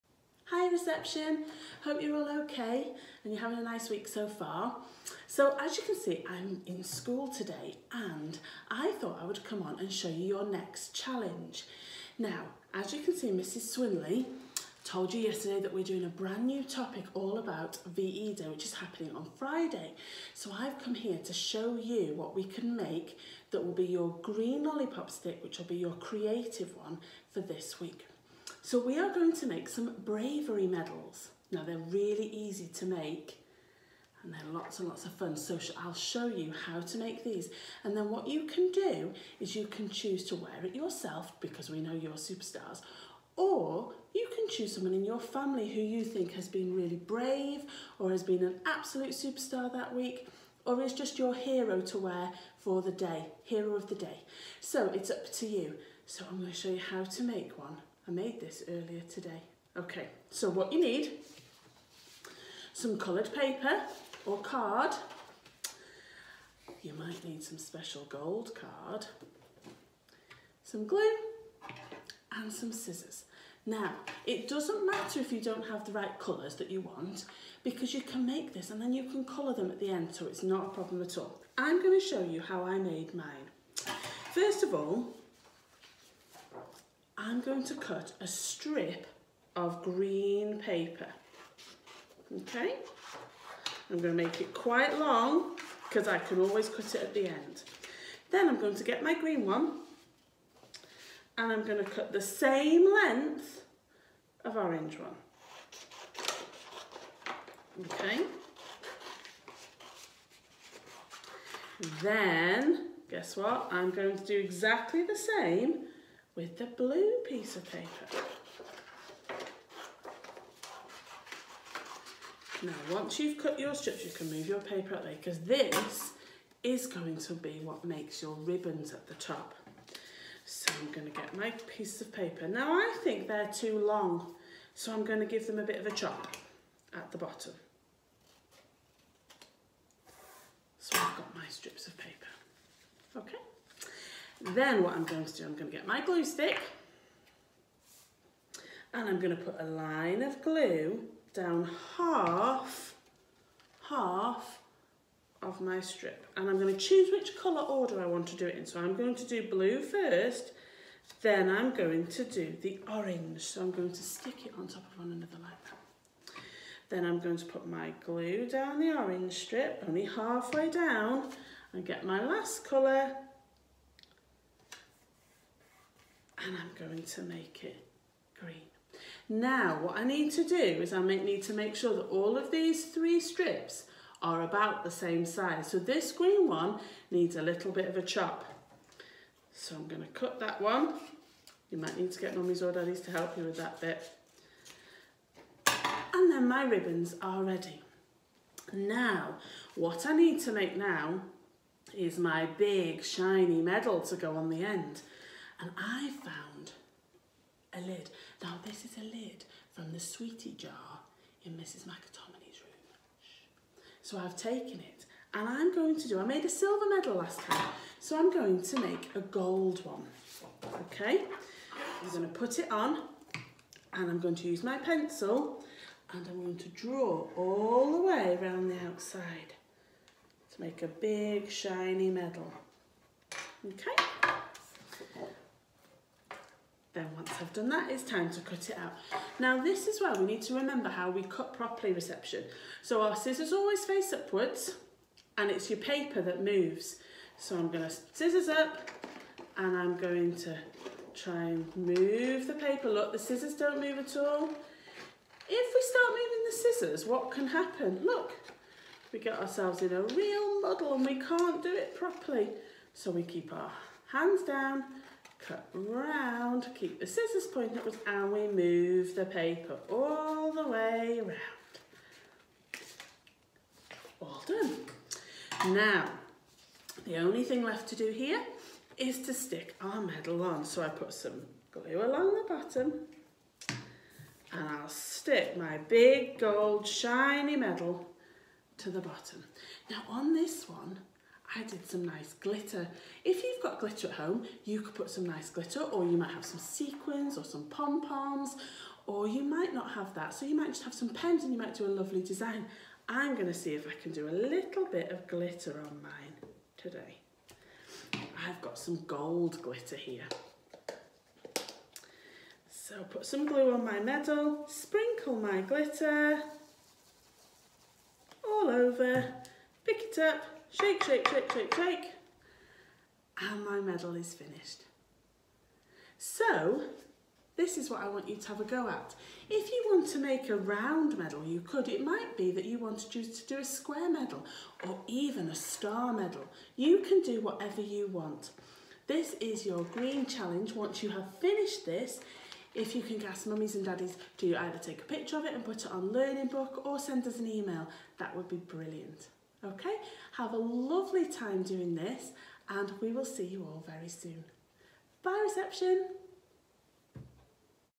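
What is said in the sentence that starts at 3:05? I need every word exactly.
So this green one needs a little bit of a chop.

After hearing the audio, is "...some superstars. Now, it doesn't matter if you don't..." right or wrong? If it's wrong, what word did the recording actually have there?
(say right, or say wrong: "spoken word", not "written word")
wrong: "scissors", not "superstars".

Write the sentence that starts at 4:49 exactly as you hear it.
Now on this one, added some nice glitter.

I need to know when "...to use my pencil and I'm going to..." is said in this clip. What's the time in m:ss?
3:44.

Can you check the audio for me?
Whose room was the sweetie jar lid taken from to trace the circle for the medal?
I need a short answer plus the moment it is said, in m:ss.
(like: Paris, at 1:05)
Mrs McAtominay, at 3:31.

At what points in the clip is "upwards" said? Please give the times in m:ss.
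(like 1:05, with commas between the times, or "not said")
4:04, 4:27.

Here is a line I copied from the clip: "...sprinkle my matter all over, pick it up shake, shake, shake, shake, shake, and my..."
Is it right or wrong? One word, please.
wrong.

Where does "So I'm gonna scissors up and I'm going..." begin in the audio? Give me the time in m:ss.
4:07.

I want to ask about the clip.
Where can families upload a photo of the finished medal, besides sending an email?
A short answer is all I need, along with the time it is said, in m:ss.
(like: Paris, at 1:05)
Learning Book, at 5:46.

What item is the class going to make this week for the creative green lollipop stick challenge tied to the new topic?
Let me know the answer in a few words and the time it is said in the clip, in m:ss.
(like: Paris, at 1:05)
bravery medals, at 0:30.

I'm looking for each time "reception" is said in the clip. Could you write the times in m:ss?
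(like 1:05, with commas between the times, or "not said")
0:00, 4:01, 5:55.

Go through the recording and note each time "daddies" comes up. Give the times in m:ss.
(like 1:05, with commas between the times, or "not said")
3:12, 5:43.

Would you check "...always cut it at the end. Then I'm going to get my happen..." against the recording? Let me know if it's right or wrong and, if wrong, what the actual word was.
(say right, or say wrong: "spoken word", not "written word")
wrong: "green", not "happen".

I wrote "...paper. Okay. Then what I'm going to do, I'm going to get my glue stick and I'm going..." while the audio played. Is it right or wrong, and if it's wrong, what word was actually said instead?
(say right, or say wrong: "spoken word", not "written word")
right.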